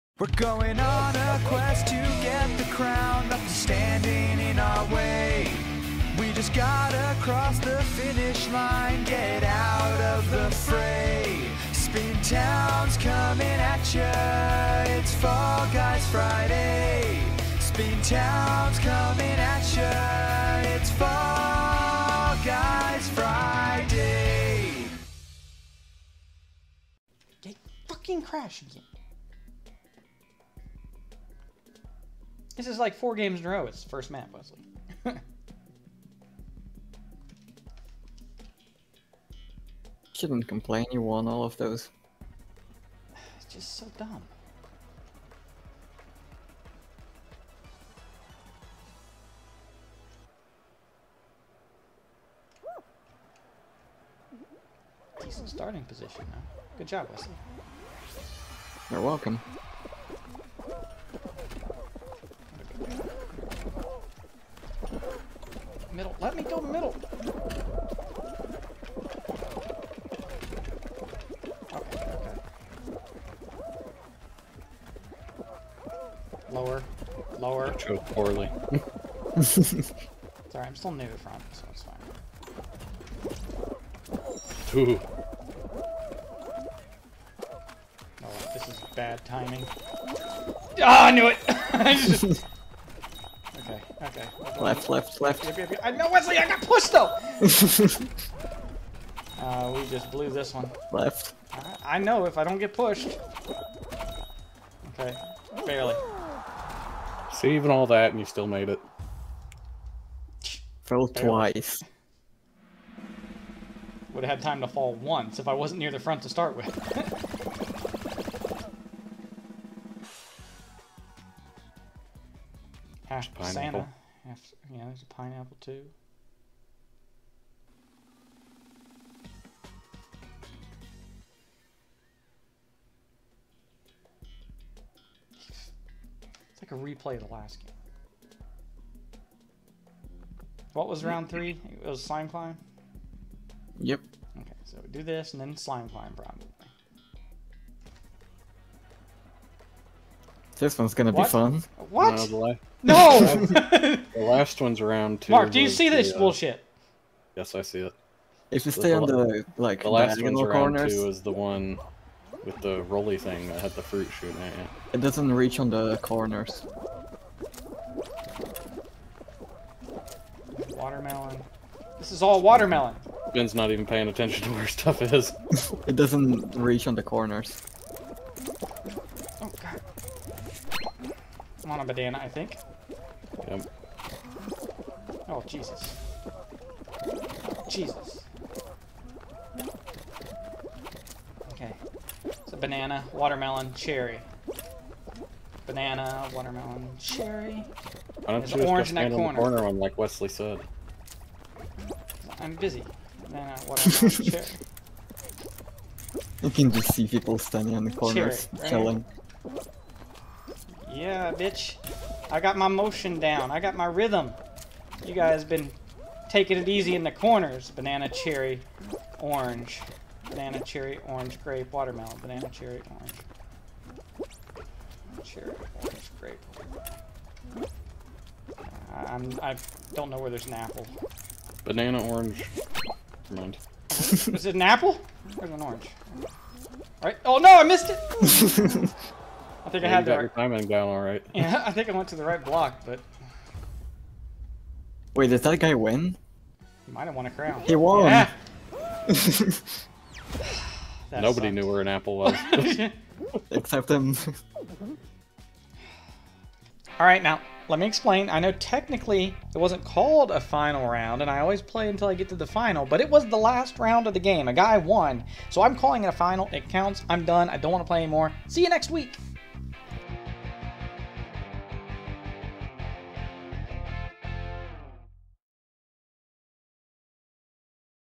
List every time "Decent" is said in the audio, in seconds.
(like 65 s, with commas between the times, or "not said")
55 s.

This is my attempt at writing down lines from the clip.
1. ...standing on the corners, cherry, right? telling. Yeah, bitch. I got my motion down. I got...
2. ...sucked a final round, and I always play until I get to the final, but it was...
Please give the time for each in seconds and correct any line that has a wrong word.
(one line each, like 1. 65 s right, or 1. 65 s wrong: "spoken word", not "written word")
1. 207 s right
2. 259 s wrong: "called", not "sucked".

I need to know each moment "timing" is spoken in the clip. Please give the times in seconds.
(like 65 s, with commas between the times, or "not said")
89 s, 240 s.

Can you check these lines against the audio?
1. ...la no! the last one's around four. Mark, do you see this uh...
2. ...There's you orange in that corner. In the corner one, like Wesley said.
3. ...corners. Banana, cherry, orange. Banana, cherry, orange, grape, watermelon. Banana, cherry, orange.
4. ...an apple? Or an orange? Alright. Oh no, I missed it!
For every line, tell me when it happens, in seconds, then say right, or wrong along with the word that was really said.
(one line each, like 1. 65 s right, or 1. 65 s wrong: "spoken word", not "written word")
1. 152 s wrong: "two", not "four"
2. 198 s right
3. 217 s right
4. 234 s right.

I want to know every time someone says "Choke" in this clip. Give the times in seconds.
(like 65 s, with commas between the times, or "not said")
77 s.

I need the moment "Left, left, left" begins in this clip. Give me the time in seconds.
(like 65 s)
94 s.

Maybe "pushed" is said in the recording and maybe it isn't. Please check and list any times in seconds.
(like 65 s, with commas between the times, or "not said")
96 s, 102 s.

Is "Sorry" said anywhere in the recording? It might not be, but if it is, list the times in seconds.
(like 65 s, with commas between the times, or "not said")
79 s.